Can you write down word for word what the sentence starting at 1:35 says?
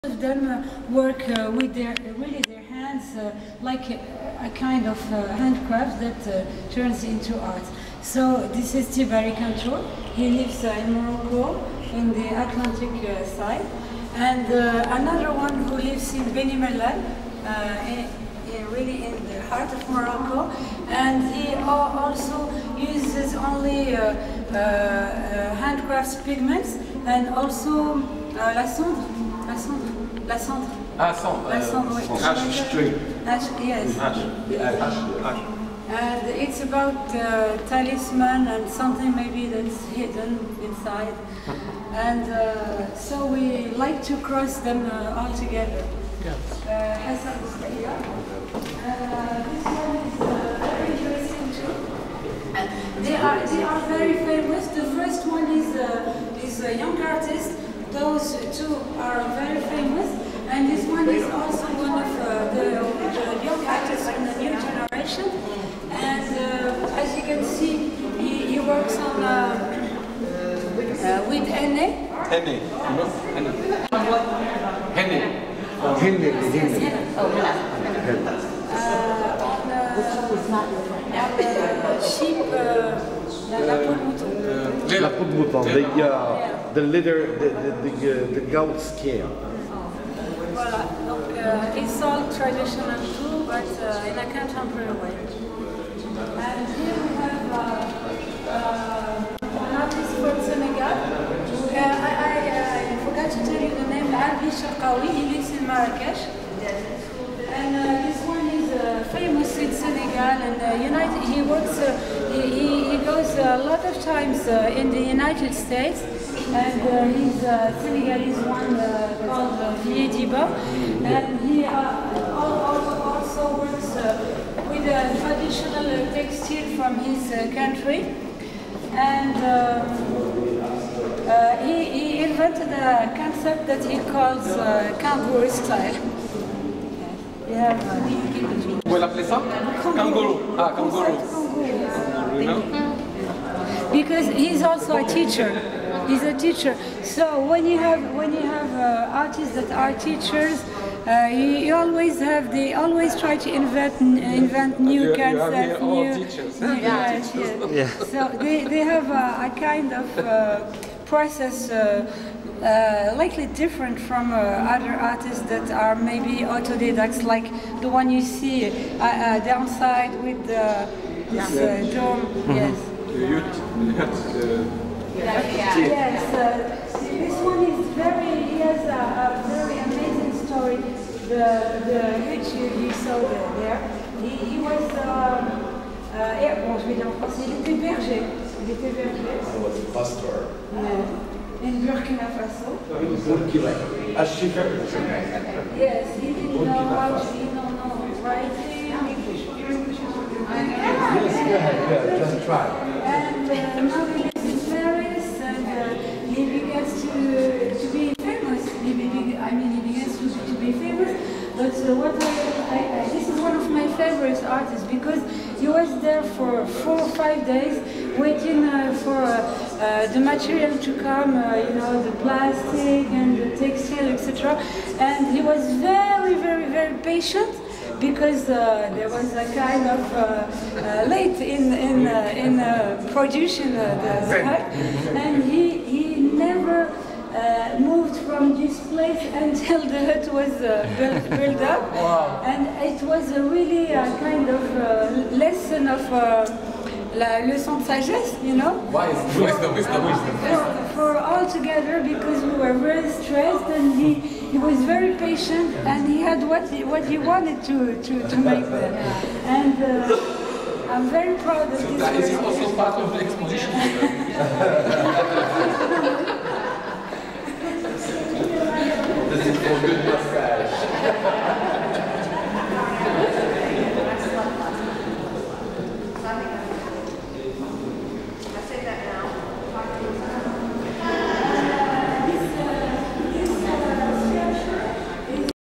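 And here we have uh, uh an artist from Senegal.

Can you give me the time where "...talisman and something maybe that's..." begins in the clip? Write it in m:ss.
0:37.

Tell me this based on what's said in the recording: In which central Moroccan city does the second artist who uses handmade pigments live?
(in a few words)
Beni Mellal.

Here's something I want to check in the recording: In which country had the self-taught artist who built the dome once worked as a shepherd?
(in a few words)
Burkina Faso.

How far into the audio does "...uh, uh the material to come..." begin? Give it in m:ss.
3:39.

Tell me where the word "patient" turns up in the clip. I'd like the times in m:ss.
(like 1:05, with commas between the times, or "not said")
3:47, 4:15.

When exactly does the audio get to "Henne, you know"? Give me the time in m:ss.
1:12.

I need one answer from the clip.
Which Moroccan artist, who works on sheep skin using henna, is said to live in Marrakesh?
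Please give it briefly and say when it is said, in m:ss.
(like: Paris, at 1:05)
Larbi Cherkaoui, at 1:44.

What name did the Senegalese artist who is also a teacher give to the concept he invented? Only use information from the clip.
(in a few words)
kangaroo style.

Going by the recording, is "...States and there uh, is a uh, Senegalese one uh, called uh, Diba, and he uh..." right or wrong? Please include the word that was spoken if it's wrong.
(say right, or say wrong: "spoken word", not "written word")
right.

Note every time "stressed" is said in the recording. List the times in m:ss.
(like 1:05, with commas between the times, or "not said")
4:13.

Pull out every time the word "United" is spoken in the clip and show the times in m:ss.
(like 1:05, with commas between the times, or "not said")
1:50, 1:55.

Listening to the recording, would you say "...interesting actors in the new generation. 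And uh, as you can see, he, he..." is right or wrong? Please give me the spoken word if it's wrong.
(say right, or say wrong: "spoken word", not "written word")
wrong: "young", not "interesting".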